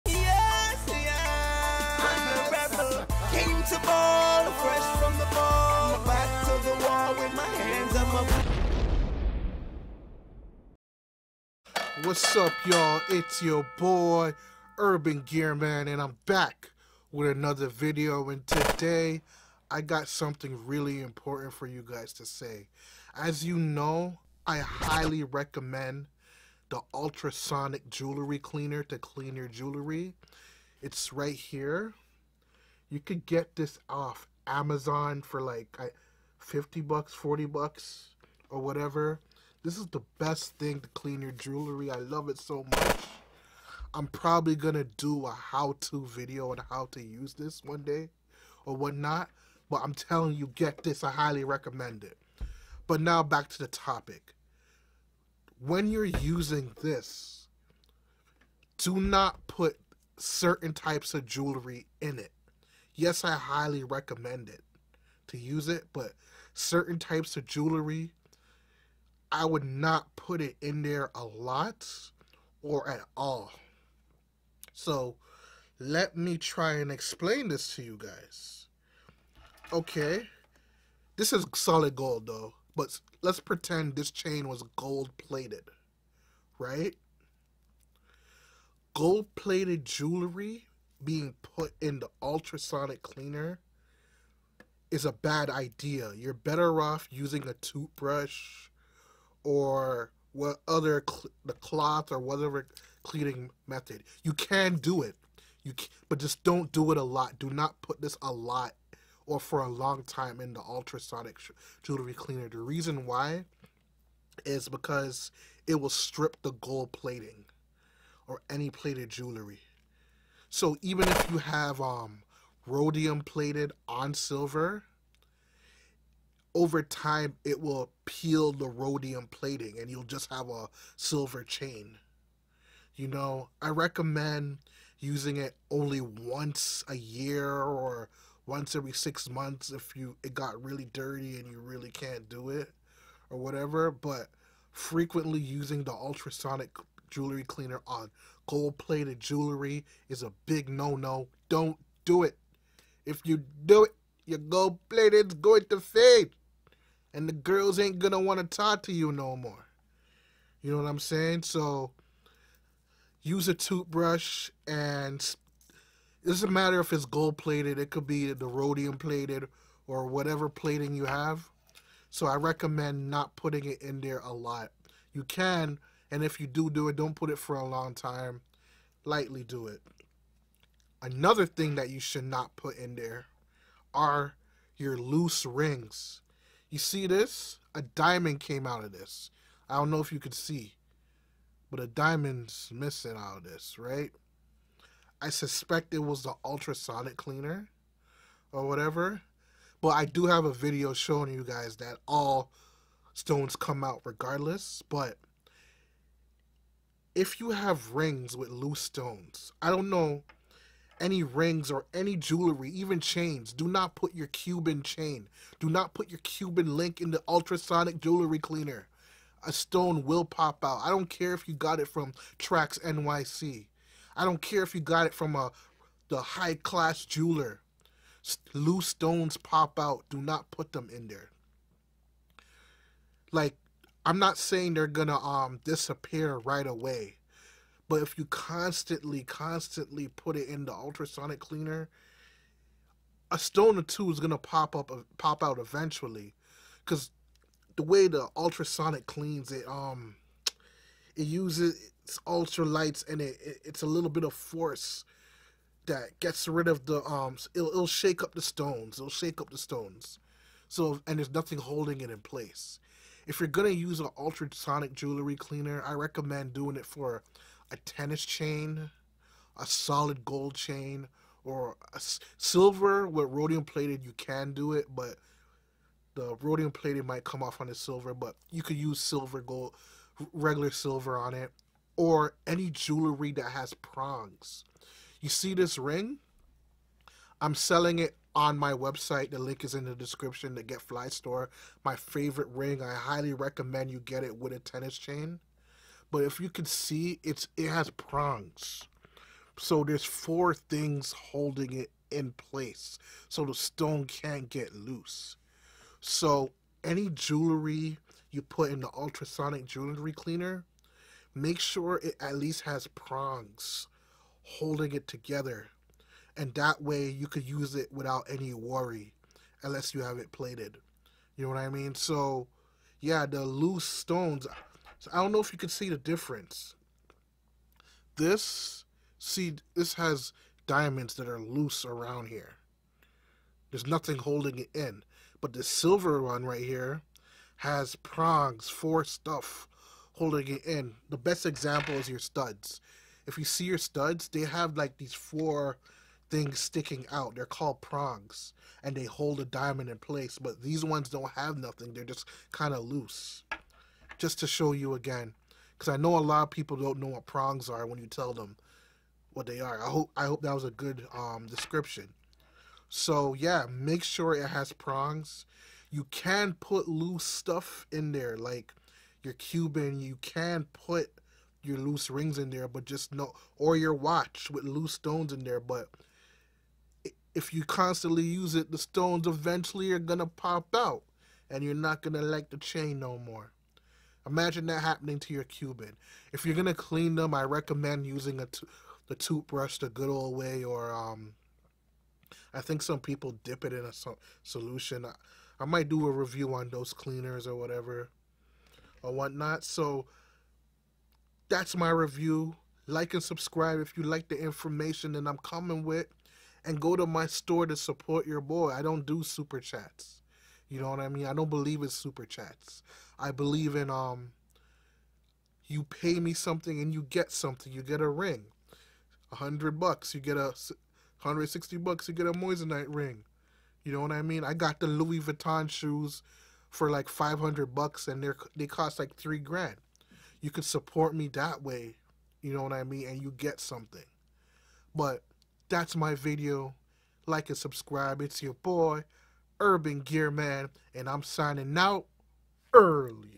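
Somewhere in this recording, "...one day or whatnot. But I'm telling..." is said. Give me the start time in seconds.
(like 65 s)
47 s.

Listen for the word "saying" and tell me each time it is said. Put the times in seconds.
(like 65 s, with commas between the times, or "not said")
160 s, 234 s.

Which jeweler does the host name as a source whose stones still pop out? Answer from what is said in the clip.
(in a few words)
Trax NYC.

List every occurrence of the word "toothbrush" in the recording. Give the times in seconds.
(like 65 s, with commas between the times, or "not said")
97 s, 163 s, 389 s.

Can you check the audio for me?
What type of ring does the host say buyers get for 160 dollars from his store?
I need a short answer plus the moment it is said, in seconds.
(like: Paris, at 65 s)
moissanite ring, at 422 s.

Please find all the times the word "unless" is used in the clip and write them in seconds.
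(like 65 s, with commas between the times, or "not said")
319 s.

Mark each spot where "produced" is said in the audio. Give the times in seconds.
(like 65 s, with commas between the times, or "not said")
not said.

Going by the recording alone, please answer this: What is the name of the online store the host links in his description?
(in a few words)
Fly Store.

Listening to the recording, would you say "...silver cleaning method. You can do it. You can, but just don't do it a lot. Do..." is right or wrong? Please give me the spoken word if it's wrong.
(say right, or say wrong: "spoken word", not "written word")
wrong: "whatever", not "silver".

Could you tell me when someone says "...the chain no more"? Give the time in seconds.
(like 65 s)
382 s.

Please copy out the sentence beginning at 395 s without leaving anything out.
I-, I might do a review on those cleaners or whatever or whatnot.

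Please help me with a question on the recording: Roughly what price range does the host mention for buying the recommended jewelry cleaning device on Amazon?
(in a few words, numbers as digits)
50 bucks.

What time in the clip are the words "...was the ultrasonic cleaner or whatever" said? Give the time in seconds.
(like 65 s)
195 s.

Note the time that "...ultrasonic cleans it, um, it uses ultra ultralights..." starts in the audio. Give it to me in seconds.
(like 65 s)
248 s.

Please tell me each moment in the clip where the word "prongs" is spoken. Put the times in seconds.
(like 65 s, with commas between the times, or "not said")
283 s, 297 s, 312 s, 337 s, 347 s, 357 s, 364 s.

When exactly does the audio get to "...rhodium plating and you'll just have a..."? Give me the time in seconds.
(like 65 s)
128 s.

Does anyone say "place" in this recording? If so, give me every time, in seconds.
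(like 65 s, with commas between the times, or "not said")
262 s, 302 s, 349 s.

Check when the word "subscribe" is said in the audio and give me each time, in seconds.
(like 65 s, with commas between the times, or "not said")
403 s, 437 s.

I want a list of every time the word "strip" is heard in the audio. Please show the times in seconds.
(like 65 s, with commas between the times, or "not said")
115 s.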